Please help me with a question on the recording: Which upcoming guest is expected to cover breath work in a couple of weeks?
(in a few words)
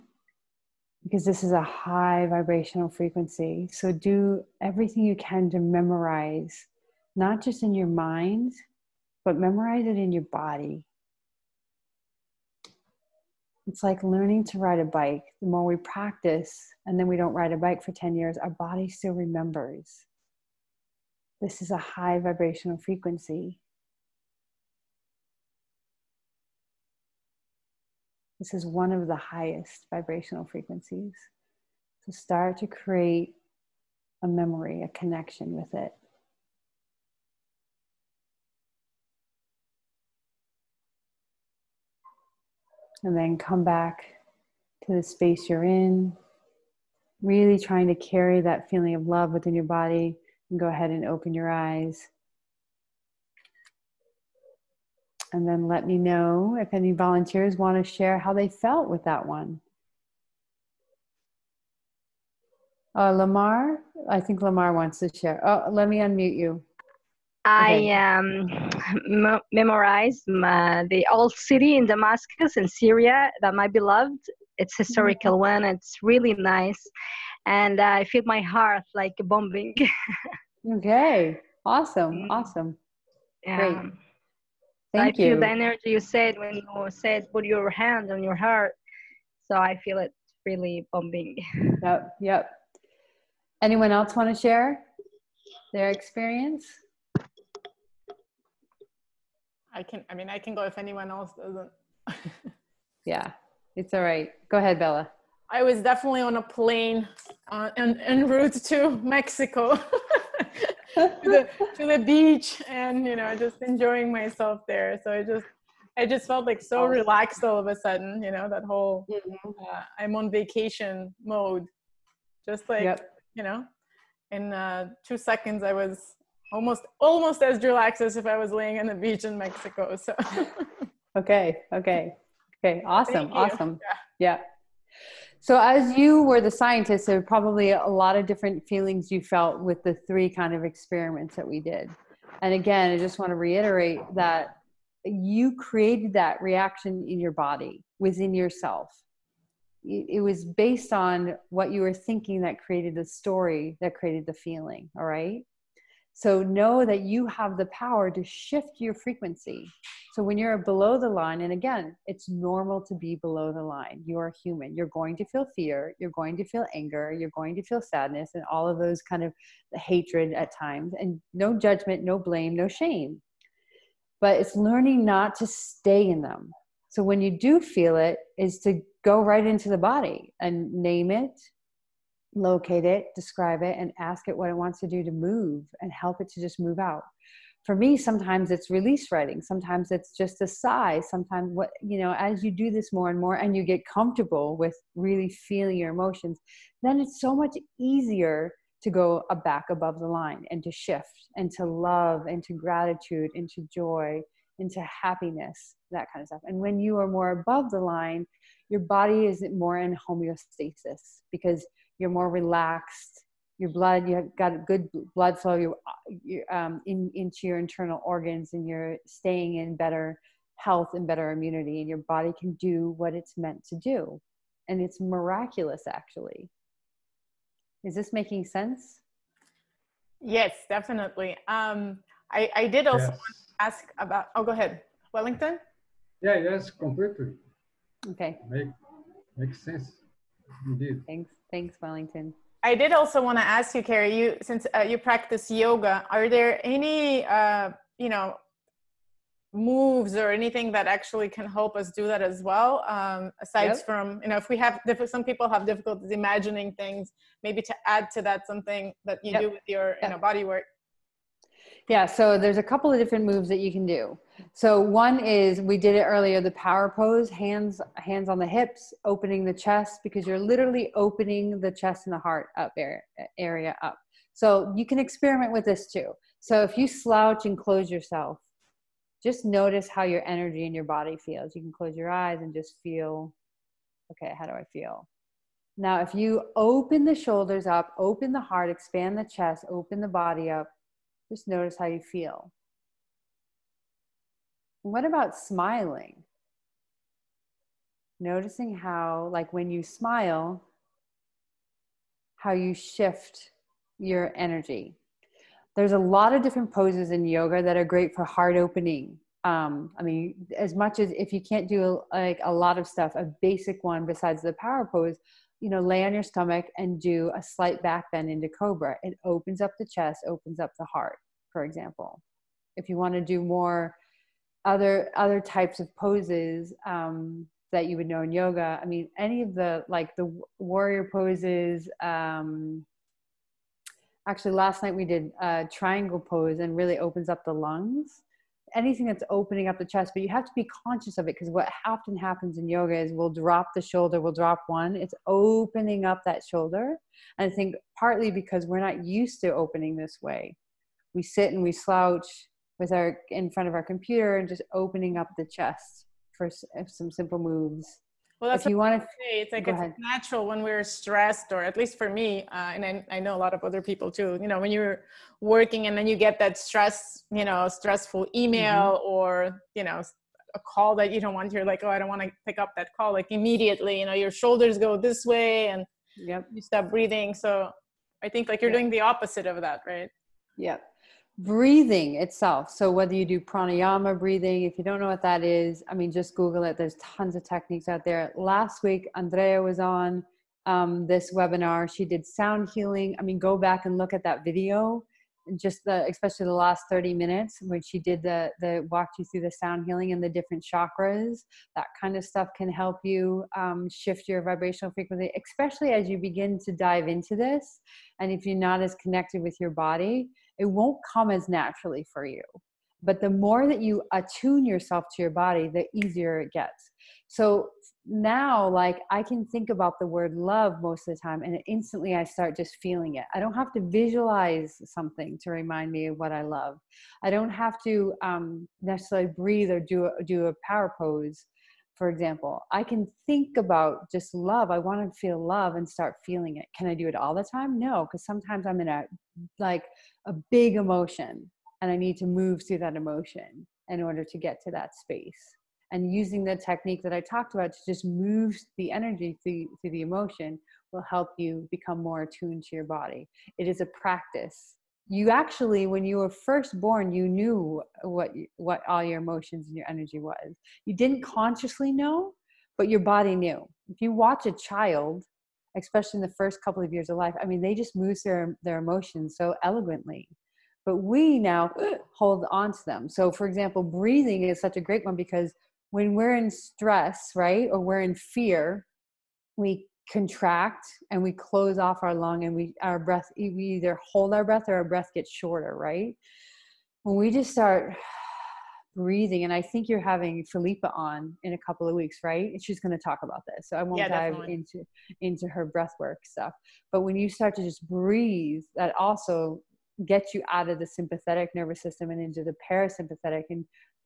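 Philippa.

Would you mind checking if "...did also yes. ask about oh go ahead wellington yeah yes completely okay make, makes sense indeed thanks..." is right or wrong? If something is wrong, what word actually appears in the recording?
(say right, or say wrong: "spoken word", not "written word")
right.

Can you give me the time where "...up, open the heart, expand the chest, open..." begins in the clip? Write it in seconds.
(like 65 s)
287 s.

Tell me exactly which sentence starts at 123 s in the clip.
you know, in uh, two seconds I was almost almost as relaxed as if I was laying on the beach in Mexico.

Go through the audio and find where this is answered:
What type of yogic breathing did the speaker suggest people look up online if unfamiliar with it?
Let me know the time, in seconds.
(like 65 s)
383 s.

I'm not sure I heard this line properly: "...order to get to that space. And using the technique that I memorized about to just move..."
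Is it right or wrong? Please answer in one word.
wrong.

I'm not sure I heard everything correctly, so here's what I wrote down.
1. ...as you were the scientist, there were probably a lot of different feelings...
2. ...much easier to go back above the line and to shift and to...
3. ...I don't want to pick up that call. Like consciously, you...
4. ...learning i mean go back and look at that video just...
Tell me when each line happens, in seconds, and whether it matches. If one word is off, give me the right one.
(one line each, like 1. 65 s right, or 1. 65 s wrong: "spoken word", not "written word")
1. 135 s right
2. 197 s right
3. 371 s wrong: "immediately", not "consciously"
4. 392 s wrong: "healing", not "learning".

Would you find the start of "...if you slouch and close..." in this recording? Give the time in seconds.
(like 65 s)
276 s.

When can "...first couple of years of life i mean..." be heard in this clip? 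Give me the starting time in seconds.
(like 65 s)
466 s.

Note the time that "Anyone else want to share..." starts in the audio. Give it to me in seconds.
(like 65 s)
93 s.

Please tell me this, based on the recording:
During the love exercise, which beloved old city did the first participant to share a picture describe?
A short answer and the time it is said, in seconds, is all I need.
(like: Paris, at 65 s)
Damascus, at 71 s.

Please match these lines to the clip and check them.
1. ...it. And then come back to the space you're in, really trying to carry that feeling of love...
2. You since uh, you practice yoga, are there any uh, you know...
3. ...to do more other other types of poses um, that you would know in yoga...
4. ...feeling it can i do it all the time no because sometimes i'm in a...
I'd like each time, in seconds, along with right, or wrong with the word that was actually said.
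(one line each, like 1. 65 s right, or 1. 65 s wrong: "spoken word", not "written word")
1. 35 s right
2. 244 s right
3. 323 s right
4. 436 s right.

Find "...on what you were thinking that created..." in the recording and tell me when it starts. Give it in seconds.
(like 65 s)
150 s.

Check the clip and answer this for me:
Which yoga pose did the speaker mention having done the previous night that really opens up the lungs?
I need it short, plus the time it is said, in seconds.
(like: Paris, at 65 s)
triangle pose, at 335 s.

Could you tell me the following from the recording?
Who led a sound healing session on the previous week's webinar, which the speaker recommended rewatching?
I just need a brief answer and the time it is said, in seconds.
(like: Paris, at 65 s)
Andrea, at 389 s.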